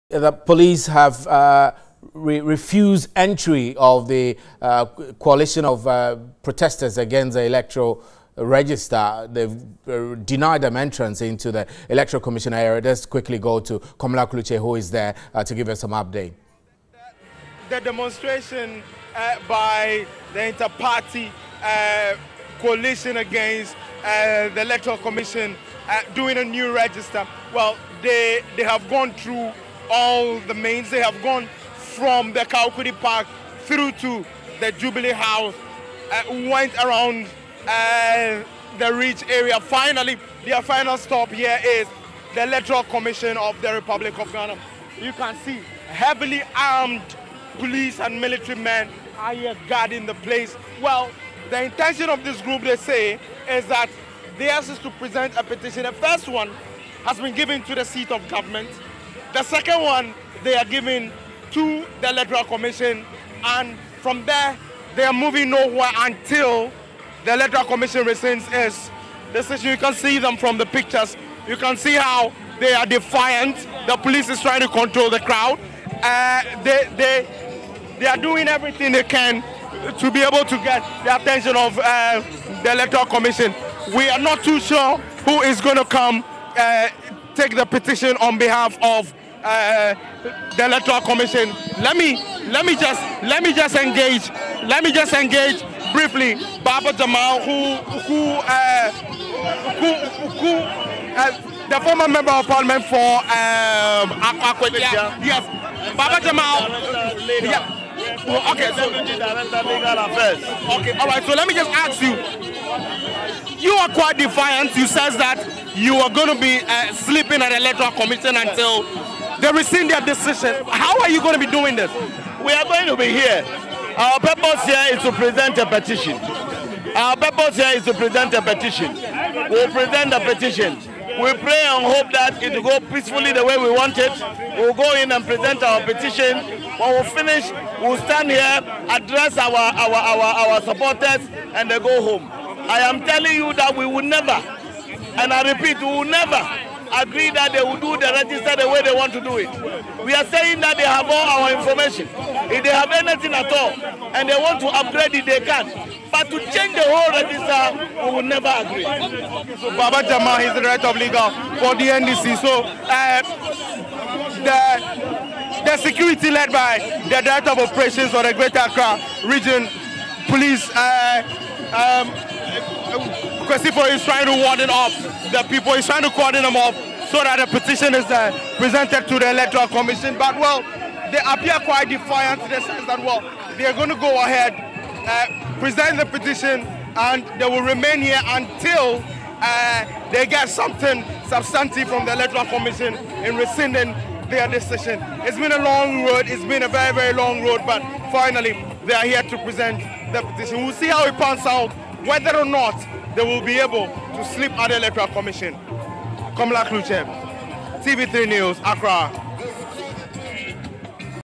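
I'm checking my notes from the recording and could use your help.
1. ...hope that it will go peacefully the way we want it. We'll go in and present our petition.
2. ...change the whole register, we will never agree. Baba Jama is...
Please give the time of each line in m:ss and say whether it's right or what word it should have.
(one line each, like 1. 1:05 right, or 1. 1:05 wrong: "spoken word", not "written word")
1. 2:11 right
2. 2:36 right.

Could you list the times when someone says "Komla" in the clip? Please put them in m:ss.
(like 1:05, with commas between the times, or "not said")
0:13, 3:26.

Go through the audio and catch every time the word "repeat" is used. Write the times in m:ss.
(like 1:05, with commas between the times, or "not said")
2:25.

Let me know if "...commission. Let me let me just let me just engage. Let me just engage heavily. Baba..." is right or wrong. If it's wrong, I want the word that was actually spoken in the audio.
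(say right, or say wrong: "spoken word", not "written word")
wrong: "briefly", not "heavily".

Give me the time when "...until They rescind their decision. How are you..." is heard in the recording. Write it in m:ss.
1:58.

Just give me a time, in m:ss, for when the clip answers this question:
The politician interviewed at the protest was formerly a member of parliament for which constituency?
1:44.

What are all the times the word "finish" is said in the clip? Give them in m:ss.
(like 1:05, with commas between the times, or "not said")
2:17.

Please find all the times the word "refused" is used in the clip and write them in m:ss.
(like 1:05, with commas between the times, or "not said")
0:02.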